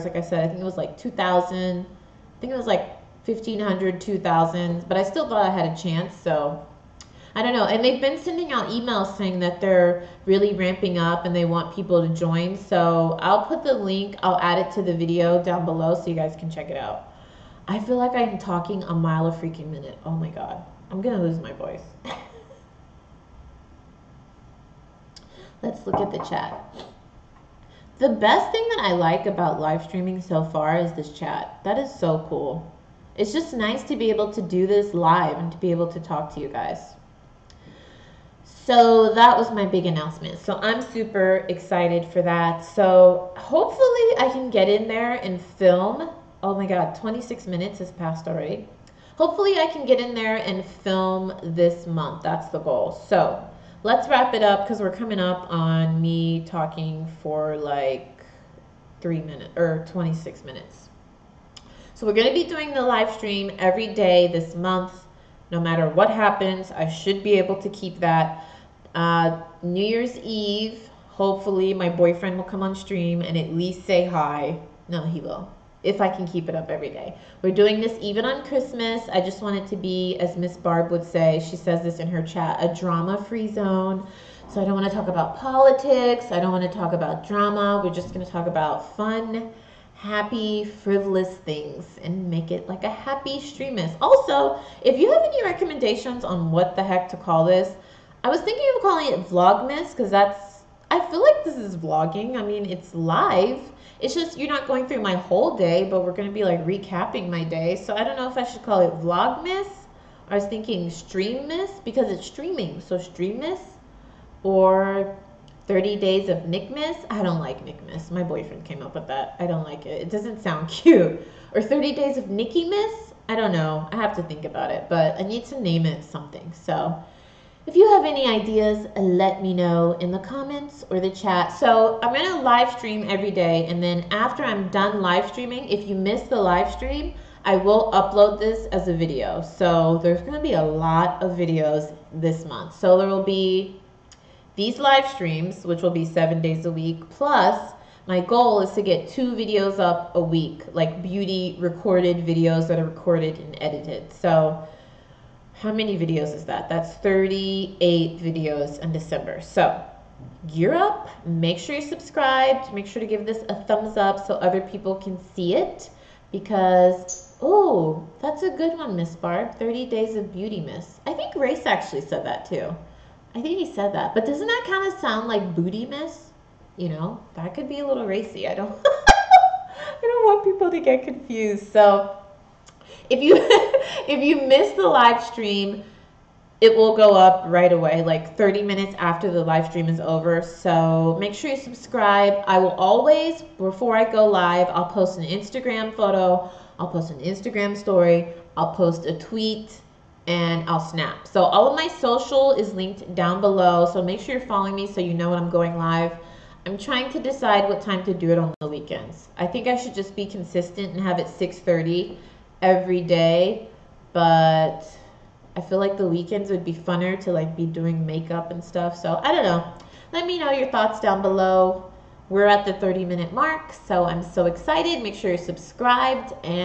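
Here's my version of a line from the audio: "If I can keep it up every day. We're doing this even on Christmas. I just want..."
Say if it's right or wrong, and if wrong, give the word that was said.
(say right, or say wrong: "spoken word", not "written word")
right.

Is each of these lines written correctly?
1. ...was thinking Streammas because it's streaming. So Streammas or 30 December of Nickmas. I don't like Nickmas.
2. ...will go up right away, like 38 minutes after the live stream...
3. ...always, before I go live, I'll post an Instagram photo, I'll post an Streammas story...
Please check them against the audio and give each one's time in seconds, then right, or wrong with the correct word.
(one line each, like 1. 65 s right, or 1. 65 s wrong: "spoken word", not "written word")
1. 110 s wrong: "Days", not "December"
2. 186 s wrong: "30", not "38"
3. 192 s wrong: "Instagram", not "Streammas".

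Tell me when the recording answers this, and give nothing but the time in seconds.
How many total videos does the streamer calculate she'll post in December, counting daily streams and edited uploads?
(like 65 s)
156 s.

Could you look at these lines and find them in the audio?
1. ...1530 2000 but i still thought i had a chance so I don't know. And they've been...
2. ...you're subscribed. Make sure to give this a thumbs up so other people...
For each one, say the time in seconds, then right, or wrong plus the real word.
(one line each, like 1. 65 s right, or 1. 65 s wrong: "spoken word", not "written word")
1. 3 s wrong: "1500", not "1530"
2. 161 s right.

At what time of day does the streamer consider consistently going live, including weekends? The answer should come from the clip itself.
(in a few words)
6:30.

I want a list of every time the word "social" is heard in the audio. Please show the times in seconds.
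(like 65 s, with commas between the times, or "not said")
201 s.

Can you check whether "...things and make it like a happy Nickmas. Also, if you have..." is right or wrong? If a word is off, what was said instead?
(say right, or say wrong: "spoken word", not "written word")
wrong: "Streammas", not "Nickmas".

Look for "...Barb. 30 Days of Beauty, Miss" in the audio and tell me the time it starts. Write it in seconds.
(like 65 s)
169 s.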